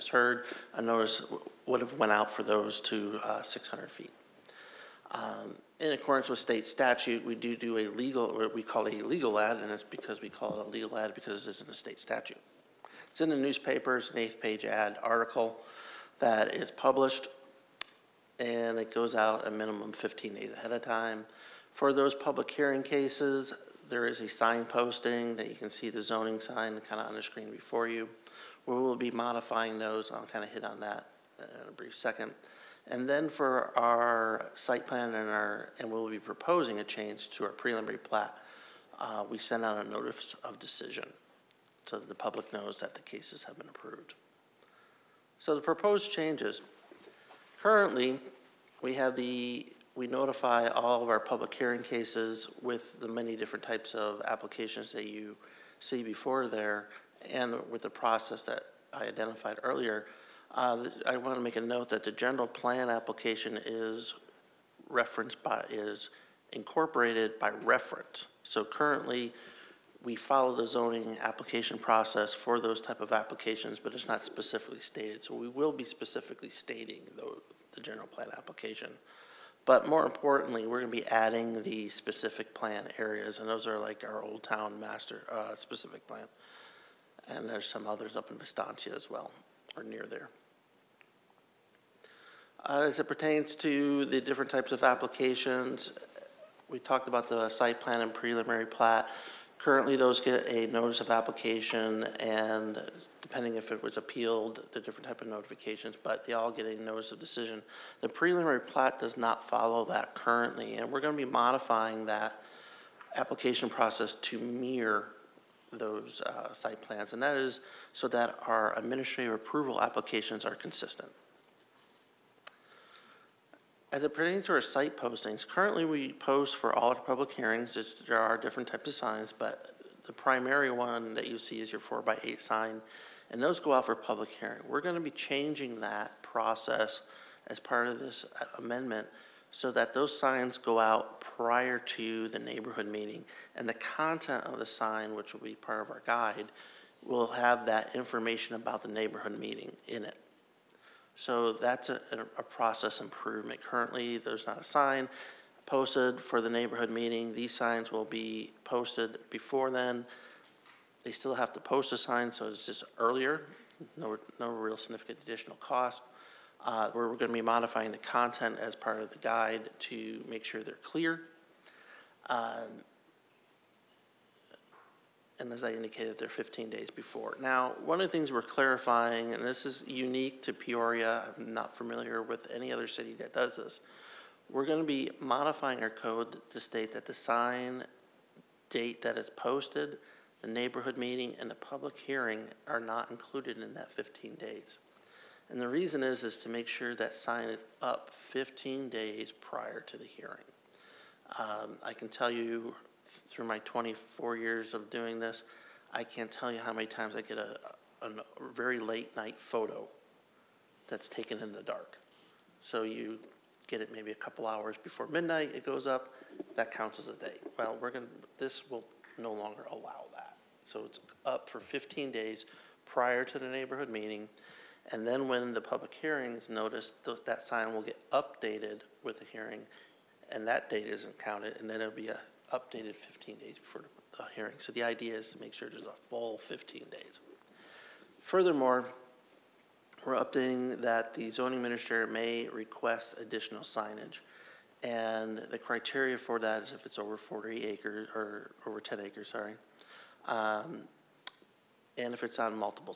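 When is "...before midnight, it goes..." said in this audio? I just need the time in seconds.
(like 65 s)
214 s.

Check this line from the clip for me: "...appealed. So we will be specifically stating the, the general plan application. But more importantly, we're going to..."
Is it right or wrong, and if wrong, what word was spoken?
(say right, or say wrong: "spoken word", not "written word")
wrong: "stated", not "appealed".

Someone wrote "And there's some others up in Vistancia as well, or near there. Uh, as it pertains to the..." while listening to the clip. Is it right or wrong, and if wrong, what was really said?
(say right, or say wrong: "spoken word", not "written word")
right.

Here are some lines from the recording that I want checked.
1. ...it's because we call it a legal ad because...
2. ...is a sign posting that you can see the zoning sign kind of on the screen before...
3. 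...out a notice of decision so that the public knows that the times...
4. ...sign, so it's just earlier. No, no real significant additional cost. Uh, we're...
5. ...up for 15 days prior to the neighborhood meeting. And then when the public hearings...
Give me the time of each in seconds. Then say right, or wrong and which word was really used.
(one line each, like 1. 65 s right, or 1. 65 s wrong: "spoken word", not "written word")
1. 9 s right
2. 24 s right
3. 39 s wrong: "cases", not "times"
4. 161 s right
5. 221 s right.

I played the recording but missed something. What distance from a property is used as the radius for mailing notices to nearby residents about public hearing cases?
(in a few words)
600 feet.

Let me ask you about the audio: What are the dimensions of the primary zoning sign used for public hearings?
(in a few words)
4 by 8.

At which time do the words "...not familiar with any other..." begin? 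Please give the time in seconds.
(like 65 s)
181 s.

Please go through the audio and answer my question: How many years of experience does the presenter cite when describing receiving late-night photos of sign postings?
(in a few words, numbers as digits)
24.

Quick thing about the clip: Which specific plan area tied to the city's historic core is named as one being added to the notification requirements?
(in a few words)
Old Town.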